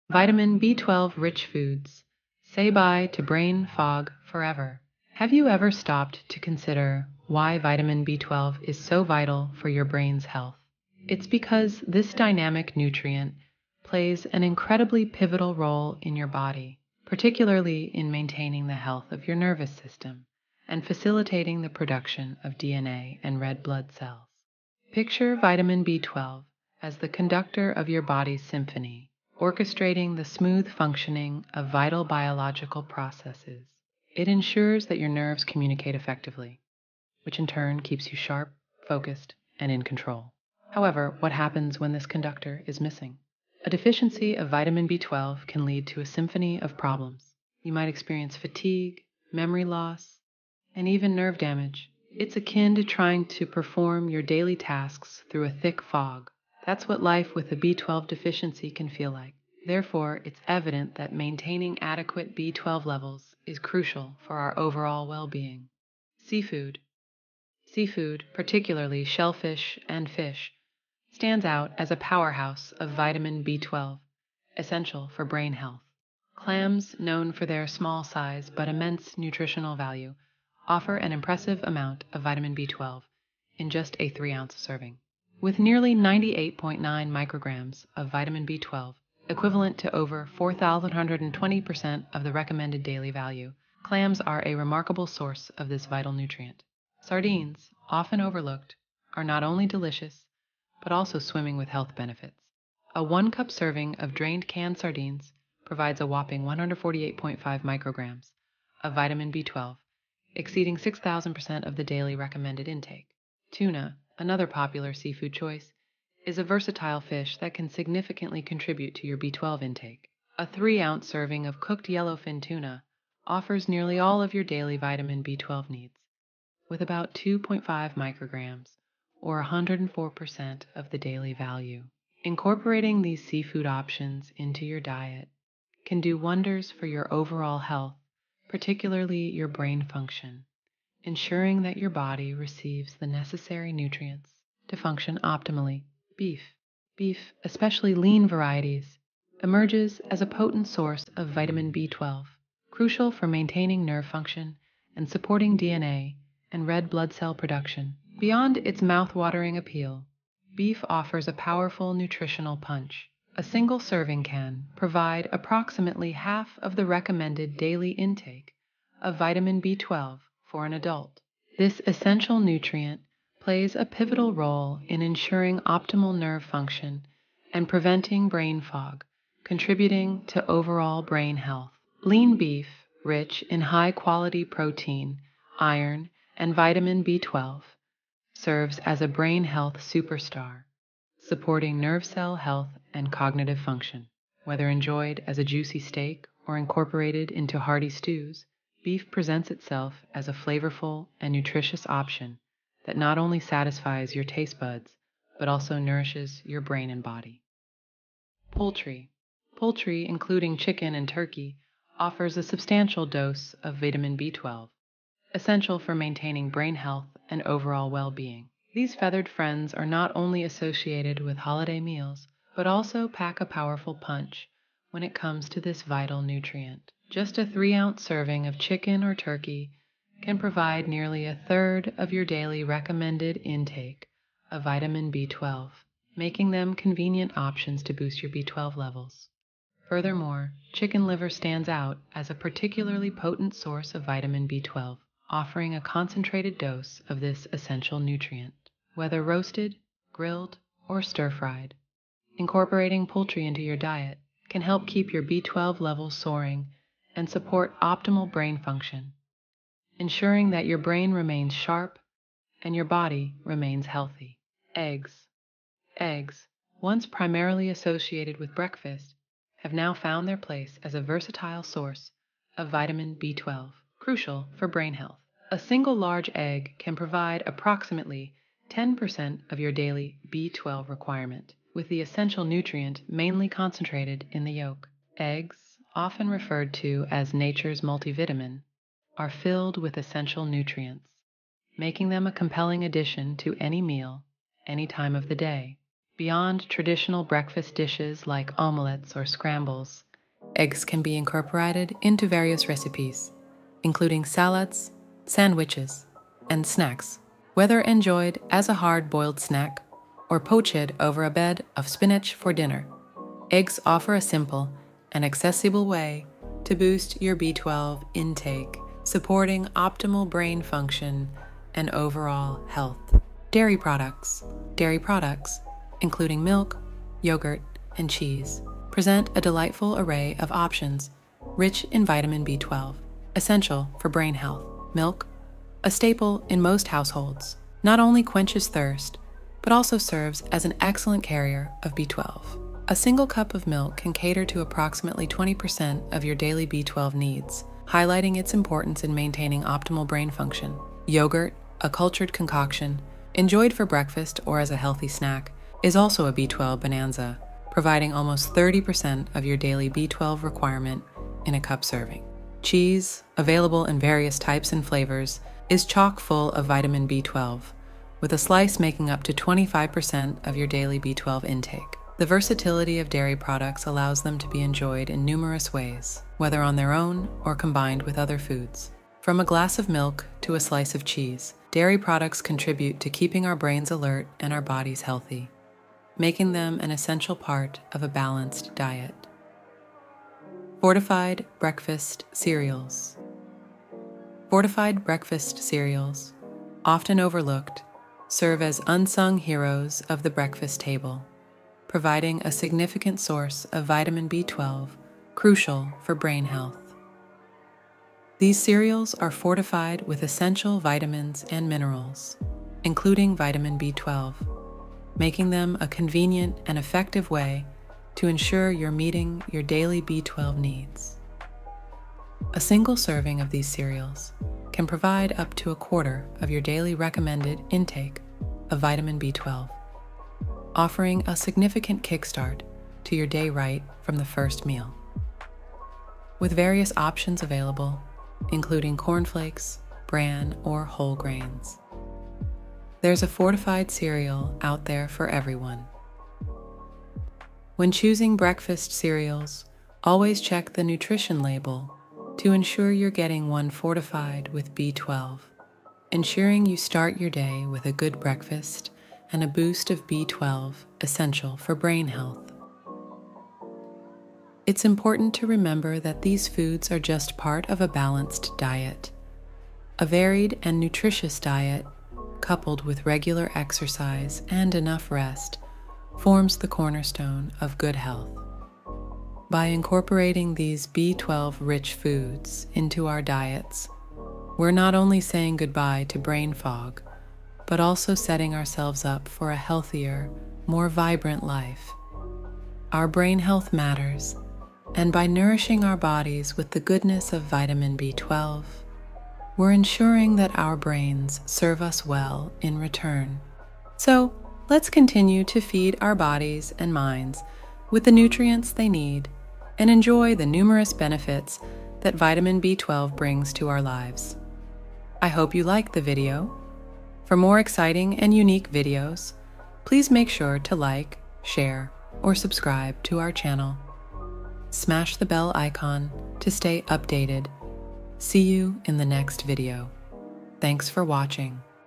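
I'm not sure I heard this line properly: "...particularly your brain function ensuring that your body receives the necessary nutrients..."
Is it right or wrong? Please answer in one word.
right.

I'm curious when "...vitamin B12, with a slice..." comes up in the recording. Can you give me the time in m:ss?
6:06.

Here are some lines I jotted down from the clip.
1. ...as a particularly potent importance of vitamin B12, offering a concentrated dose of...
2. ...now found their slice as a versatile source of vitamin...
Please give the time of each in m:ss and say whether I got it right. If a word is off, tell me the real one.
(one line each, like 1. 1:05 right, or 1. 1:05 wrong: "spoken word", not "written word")
1. 4:02 wrong: "source", not "importance"
2. 4:29 wrong: "place", not "slice".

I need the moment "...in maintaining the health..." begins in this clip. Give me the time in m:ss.
0:17.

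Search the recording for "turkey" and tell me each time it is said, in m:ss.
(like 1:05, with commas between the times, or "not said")
3:31, 3:49.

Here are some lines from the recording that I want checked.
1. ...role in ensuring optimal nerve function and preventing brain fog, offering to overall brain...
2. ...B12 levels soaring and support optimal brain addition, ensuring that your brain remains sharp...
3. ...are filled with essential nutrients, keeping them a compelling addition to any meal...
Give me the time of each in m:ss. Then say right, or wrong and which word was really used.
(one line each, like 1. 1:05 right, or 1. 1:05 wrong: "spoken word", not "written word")
1. 2:54 wrong: "contributing", not "offering"
2. 4:15 wrong: "function", not "addition"
3. 4:49 wrong: "making", not "keeping".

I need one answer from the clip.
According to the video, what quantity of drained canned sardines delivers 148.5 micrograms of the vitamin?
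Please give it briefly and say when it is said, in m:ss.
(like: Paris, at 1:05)
one cup, at 1:43.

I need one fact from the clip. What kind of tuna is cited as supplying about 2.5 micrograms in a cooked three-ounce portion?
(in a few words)
yellowfin.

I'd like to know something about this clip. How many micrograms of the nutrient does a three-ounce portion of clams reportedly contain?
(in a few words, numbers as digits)
98.9 micrograms.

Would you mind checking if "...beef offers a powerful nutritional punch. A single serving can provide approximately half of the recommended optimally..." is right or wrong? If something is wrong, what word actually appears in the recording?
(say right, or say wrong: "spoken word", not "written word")
wrong: "daily", not "optimally".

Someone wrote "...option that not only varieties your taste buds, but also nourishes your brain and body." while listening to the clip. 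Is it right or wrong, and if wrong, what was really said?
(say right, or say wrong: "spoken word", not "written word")
wrong: "satisfies", not "varieties".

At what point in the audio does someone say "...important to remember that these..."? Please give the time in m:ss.
7:44.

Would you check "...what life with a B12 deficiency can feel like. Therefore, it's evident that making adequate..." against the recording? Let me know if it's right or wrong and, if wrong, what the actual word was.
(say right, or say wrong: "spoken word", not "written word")
wrong: "maintaining", not "making".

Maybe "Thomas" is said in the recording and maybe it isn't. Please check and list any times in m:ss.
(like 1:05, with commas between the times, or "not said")
not said.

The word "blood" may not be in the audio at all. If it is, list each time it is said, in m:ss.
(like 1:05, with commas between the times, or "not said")
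0:23, 2:36.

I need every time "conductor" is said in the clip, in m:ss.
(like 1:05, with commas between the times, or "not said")
0:27, 0:42.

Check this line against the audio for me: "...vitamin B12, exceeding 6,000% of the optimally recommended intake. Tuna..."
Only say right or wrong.
wrong.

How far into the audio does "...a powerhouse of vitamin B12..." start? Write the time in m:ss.
1:11.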